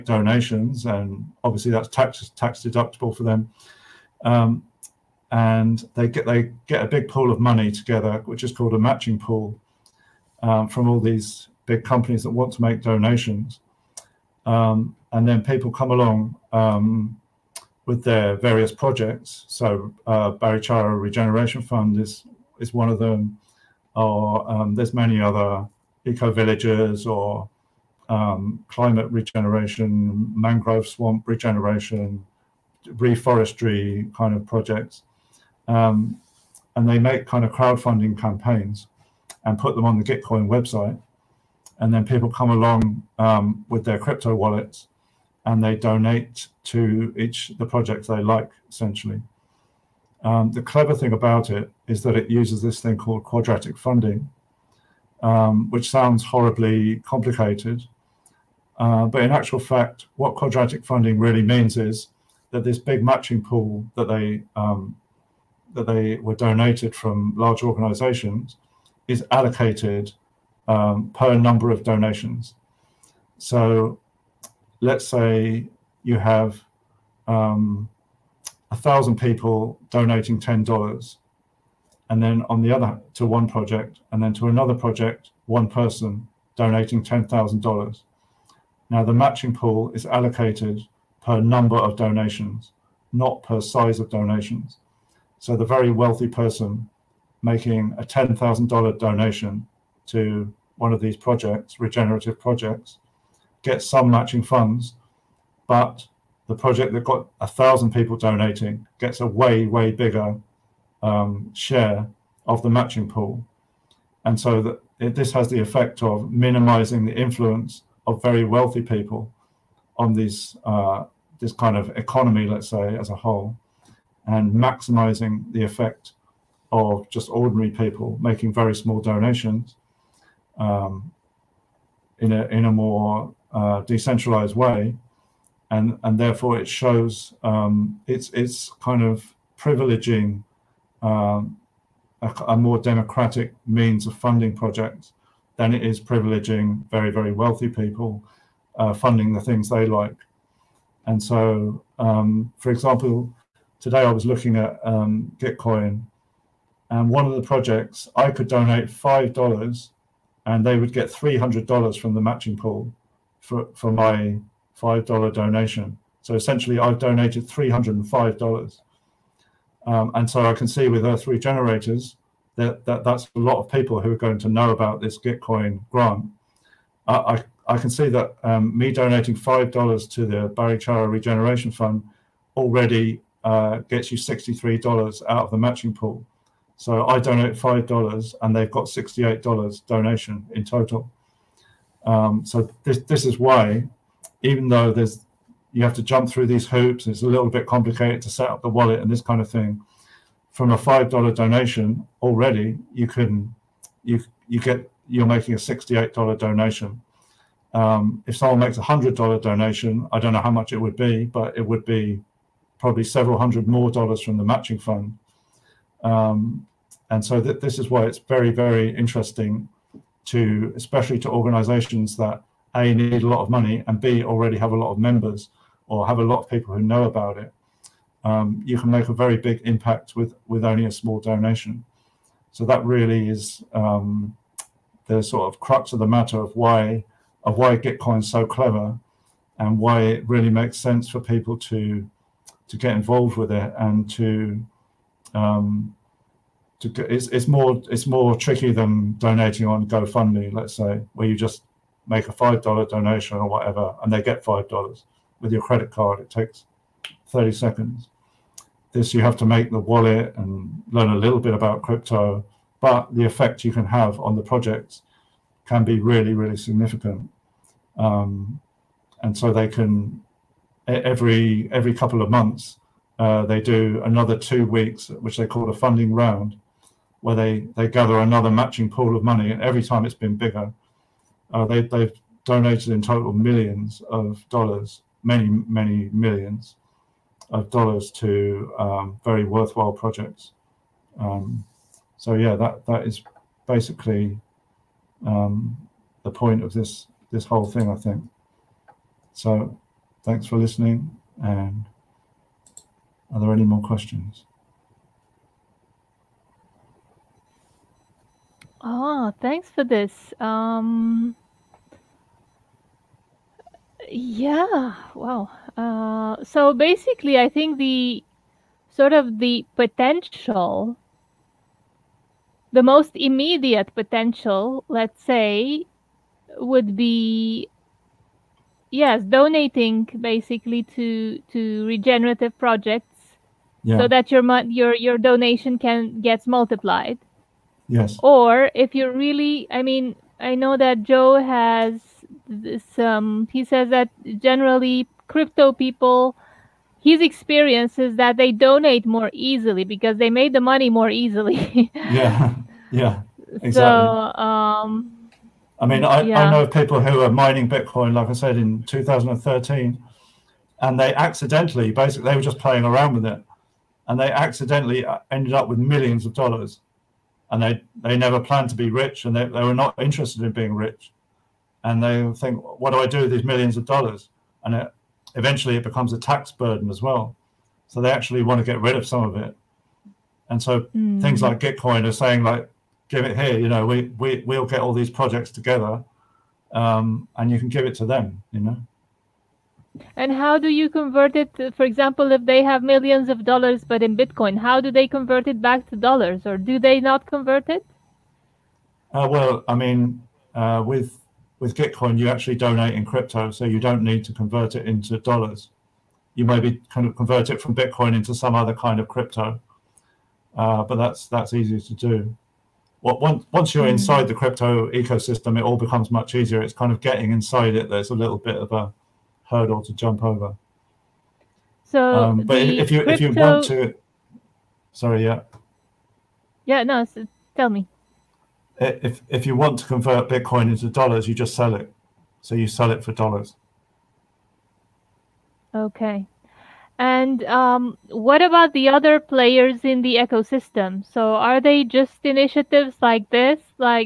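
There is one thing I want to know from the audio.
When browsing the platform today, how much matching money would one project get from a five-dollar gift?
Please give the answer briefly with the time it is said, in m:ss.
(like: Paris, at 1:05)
$300, at 2:41.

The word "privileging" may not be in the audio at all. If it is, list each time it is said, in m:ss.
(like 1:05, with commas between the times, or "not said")
2:19, 2:25.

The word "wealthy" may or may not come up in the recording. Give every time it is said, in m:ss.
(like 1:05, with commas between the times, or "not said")
1:35, 1:58, 2:27.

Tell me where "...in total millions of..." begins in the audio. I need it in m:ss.
4:42.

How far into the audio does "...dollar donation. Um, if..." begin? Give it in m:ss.
3:26.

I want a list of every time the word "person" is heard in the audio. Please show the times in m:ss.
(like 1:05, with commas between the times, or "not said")
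1:25, 1:36.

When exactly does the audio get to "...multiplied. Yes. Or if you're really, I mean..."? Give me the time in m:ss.
5:36.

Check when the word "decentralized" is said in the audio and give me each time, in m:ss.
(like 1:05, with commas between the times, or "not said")
2:13.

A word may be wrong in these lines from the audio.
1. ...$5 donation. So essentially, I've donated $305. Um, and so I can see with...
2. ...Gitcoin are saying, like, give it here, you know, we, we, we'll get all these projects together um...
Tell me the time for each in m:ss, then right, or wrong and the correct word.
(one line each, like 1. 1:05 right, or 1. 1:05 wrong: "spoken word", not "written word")
1. 2:44 right
2. 6:21 right.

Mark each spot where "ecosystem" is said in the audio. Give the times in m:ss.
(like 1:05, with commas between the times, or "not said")
6:54, 7:20.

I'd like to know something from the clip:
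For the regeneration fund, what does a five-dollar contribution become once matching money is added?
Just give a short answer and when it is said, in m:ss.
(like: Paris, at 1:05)
$68, at 3:08.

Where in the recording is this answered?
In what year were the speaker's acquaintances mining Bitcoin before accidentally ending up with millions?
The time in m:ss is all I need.
5:58.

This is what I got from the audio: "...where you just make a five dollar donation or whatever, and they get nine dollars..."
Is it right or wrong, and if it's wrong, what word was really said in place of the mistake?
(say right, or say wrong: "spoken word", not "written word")
wrong: "five", not "nine".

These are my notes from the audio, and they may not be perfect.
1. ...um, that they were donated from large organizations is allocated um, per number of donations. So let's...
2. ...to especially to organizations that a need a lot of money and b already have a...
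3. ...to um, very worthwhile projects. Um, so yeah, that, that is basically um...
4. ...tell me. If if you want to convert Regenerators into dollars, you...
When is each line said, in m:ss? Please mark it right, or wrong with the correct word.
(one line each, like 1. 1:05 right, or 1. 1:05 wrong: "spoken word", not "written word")
1. 1:04 right
2. 3:40 right
3. 4:48 right
4. 7:07 wrong: "Bitcoin", not "Regenerators".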